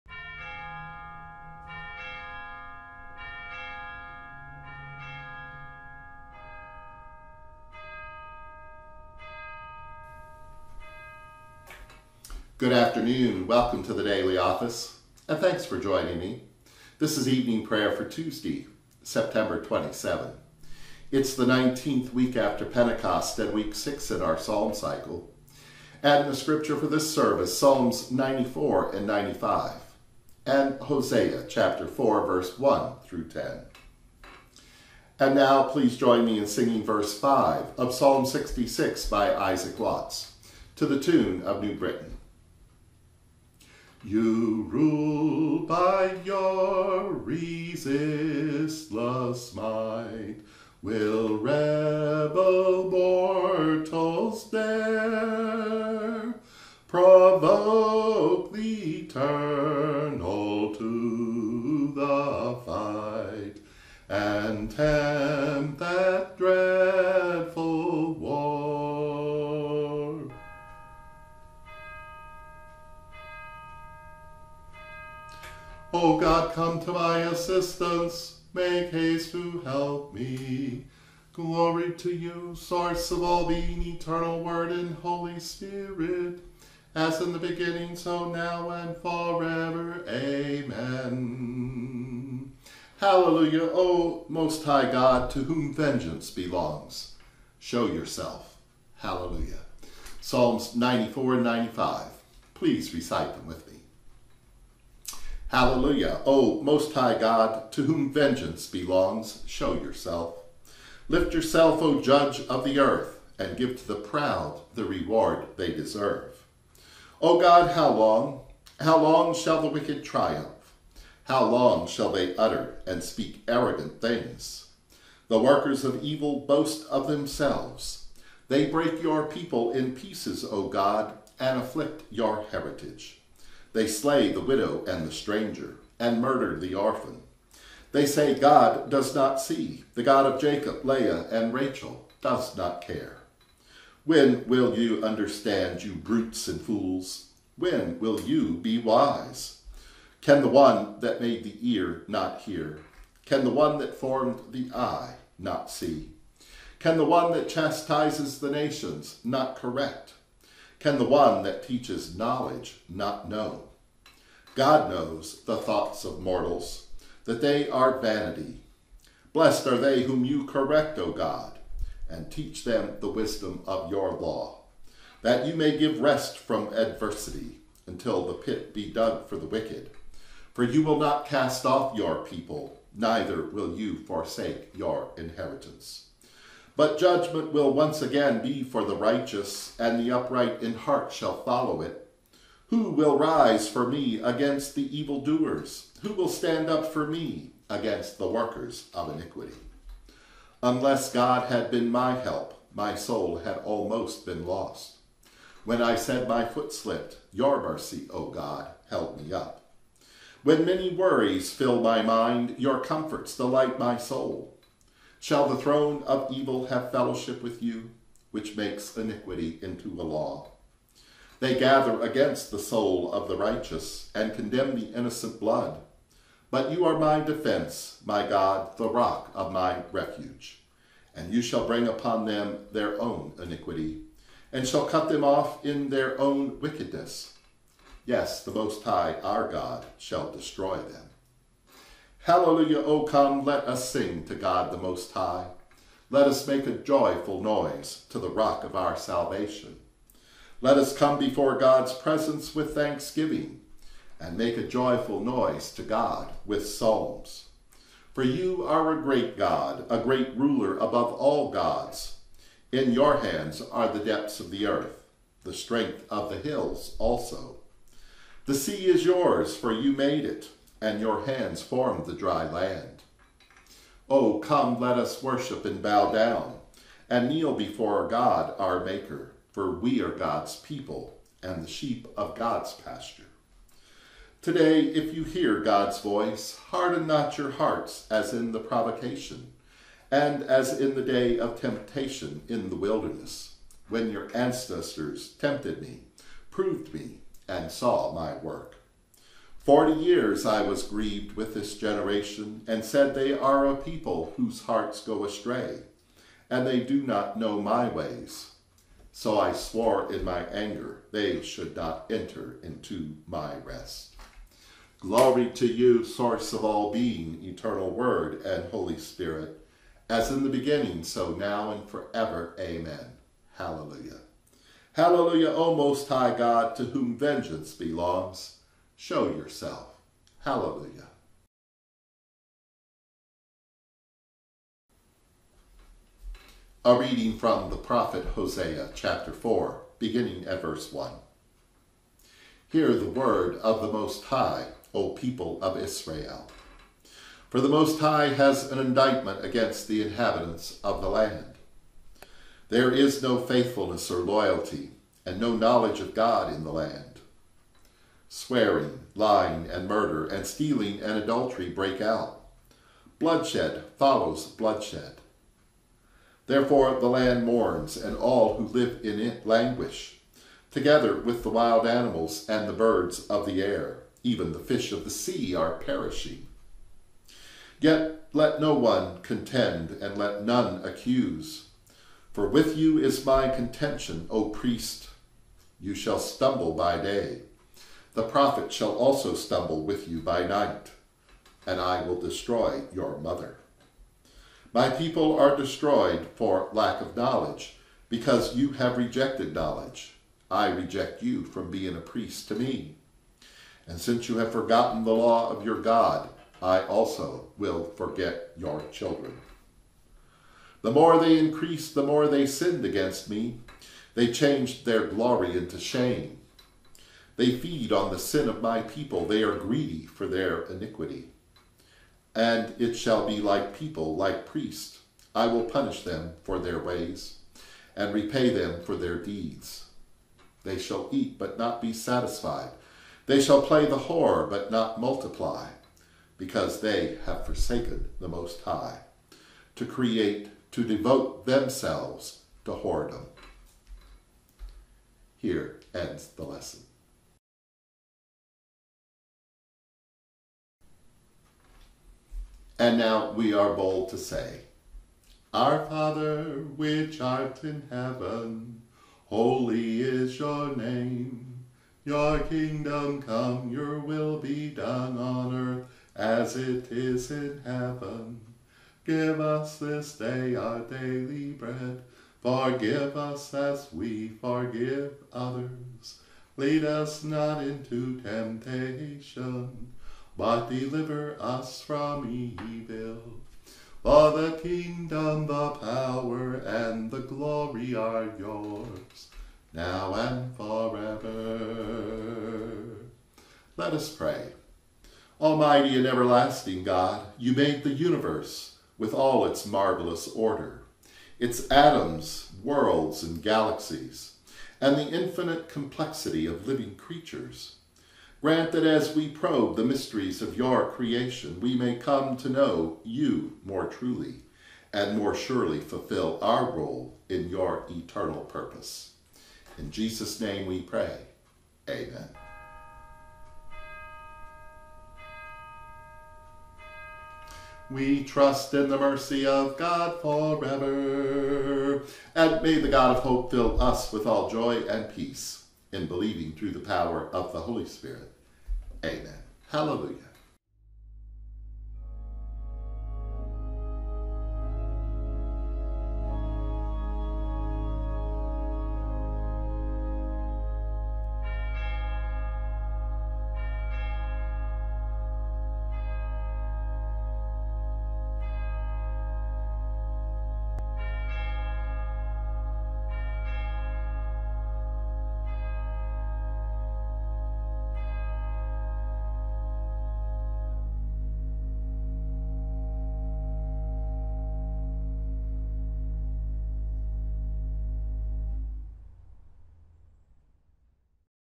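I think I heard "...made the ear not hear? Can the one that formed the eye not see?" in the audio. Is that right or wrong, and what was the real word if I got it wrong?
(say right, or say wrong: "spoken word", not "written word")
right.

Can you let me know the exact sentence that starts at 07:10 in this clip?
They shall eat, but not be satisfied.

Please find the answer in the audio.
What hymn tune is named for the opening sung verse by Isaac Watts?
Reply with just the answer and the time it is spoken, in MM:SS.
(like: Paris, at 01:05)
New Britain, at 00:41.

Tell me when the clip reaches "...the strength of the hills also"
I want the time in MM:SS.
04:25.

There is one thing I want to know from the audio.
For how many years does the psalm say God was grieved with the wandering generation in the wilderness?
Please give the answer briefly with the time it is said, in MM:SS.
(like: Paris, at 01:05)
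40, at 04:59.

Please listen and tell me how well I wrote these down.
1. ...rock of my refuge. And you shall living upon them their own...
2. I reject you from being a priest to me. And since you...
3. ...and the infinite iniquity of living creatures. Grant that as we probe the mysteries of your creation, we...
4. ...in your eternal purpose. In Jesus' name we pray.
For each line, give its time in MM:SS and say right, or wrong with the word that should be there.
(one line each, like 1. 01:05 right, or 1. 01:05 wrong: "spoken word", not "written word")
1. 03:48 wrong: "bring", not "living"
2. 06:40 right
3. 08:24 wrong: "complexity", not "iniquity"
4. 08:37 right.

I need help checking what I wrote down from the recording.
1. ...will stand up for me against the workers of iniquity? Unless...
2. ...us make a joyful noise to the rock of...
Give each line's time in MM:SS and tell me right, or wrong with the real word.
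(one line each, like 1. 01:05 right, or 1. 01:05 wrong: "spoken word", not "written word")
1. 03:16 right
2. 04:06 right.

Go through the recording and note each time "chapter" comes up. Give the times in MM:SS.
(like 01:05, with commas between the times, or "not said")
00:31, 05:38.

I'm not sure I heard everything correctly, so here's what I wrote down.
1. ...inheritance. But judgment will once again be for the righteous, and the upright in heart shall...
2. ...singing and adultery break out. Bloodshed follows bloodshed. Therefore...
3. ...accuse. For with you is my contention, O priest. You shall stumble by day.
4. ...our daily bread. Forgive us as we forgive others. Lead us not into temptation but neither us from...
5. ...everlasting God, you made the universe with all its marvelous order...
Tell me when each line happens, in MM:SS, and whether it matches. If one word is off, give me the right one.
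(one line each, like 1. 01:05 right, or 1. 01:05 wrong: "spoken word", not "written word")
1. 03:05 right
2. 06:00 wrong: "stealing", not "singing"
3. 06:20 right
4. 07:50 wrong: "deliver", not "neither"
5. 08:16 right.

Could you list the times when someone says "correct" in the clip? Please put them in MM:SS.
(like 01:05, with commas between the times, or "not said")
02:39, 02:50.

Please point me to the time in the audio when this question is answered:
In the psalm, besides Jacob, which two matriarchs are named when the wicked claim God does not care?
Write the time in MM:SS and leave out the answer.
02:20.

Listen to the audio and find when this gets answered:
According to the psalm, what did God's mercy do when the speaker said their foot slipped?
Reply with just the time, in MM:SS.
03:28.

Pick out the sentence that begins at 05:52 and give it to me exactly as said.
There is no faithfulness or loyalty, and no knowledge of God in the land.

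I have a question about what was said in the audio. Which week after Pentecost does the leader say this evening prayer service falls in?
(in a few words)
19th.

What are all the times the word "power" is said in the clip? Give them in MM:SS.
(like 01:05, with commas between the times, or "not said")
08:05, 08:56.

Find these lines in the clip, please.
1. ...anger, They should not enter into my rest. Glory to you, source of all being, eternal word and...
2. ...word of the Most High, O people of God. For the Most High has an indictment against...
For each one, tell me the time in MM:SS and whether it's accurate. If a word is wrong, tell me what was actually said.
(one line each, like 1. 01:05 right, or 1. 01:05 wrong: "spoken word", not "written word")
1. 05:10 right
2. 05:43 wrong: "Israel", not "God".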